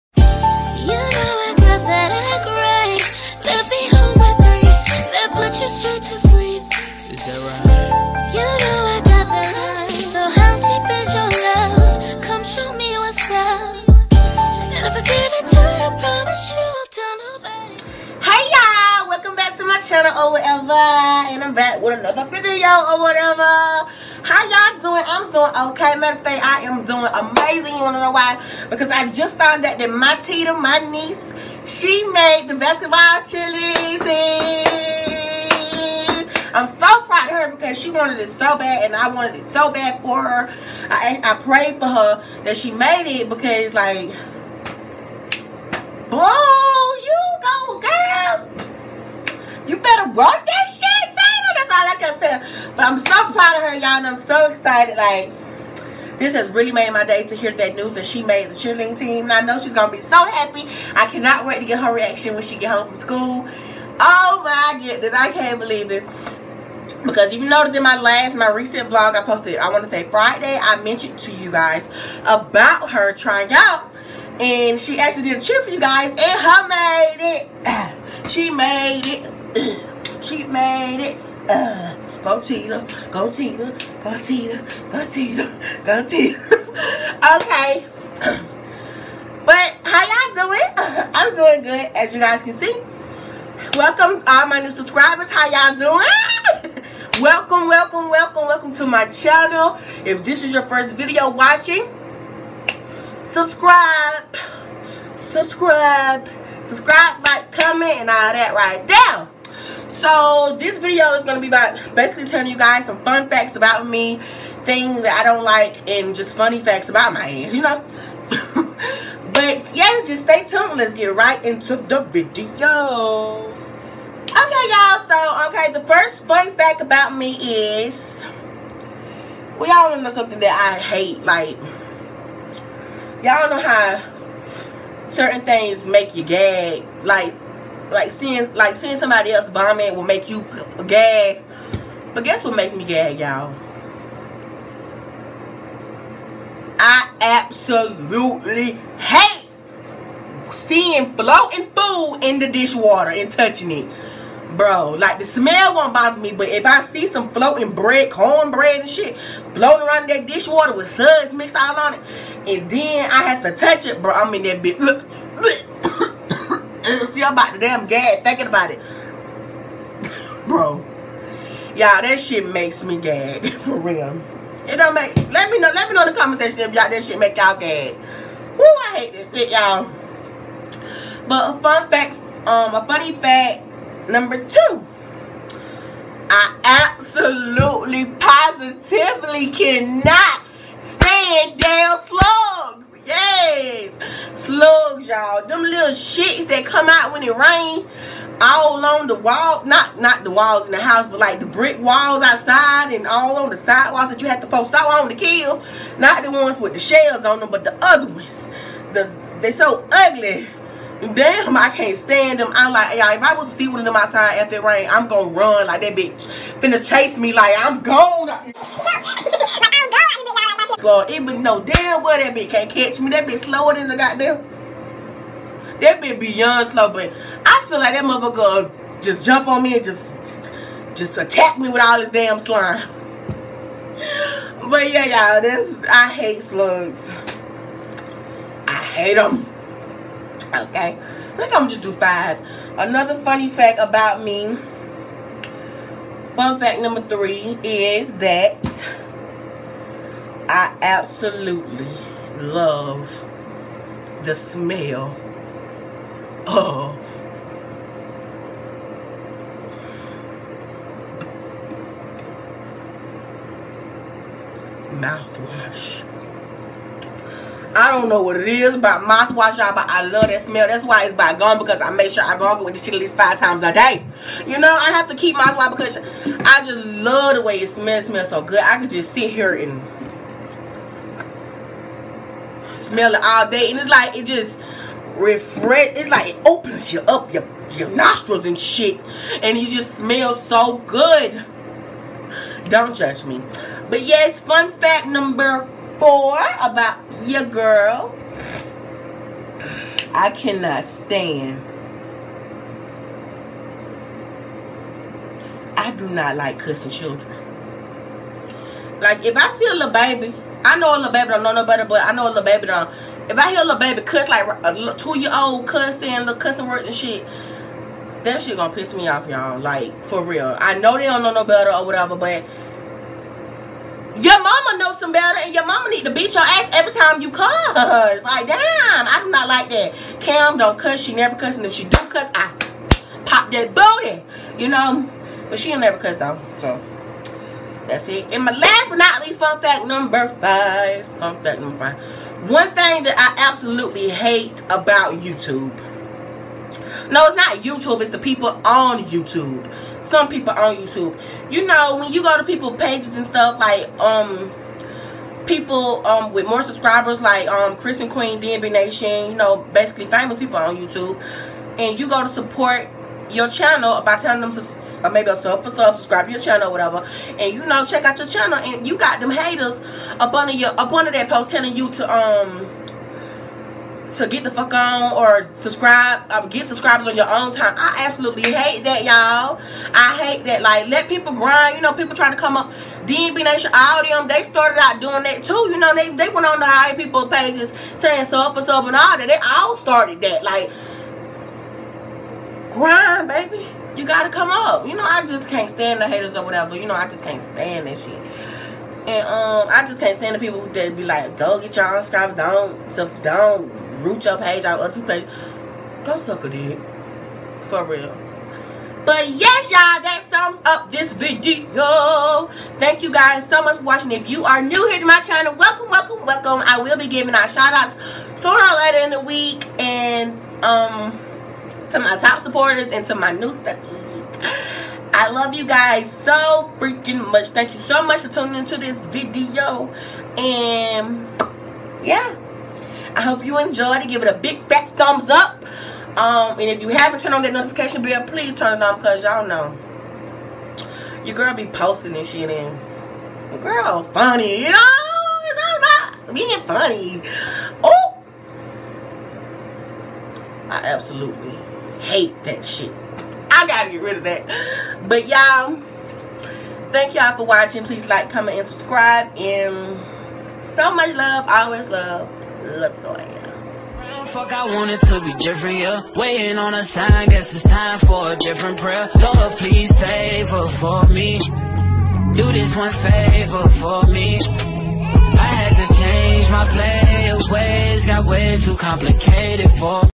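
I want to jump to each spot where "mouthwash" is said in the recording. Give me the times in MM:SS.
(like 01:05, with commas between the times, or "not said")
04:24, 04:29, 04:35.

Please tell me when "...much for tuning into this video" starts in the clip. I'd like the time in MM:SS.
07:08.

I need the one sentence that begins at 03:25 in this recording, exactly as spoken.
Not the ones with the shells on them, but the other ones.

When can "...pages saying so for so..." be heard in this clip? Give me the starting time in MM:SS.
06:27.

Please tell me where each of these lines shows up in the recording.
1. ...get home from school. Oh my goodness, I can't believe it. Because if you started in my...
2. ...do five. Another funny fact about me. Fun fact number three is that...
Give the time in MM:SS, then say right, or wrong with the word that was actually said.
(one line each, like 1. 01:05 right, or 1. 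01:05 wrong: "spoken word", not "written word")
1. 01:02 wrong: "noticed", not "started"
2. 04:01 right.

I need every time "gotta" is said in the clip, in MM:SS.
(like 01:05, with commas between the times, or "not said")
06:34, 07:33.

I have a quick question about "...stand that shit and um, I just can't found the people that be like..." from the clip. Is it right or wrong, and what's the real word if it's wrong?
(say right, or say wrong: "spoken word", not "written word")
wrong: "stand", not "found".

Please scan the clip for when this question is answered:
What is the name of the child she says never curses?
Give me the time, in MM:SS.
05:30.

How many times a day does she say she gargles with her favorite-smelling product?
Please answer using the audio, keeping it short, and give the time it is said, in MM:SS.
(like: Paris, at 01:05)
5, at 04:33.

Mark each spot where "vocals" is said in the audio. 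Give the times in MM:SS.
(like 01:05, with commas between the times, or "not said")
not said.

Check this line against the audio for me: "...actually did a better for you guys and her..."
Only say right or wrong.
wrong.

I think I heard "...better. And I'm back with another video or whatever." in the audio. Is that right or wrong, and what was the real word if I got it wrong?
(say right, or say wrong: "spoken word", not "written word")
wrong: "whatever", not "better".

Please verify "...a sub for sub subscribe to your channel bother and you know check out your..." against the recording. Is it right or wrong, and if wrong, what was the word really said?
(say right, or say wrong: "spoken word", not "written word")
wrong: "whatever", not "bother".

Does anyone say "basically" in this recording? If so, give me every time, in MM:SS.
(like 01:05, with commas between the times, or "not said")
01:51, 05:59.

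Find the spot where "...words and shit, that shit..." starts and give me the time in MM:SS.
05:16.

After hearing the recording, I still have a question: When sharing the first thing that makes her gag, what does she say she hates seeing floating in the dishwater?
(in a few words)
bread.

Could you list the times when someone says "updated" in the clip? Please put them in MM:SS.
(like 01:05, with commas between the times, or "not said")
not said.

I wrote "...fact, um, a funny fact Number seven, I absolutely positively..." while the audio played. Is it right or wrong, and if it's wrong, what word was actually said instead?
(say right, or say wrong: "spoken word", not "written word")
wrong: "two", not "seven".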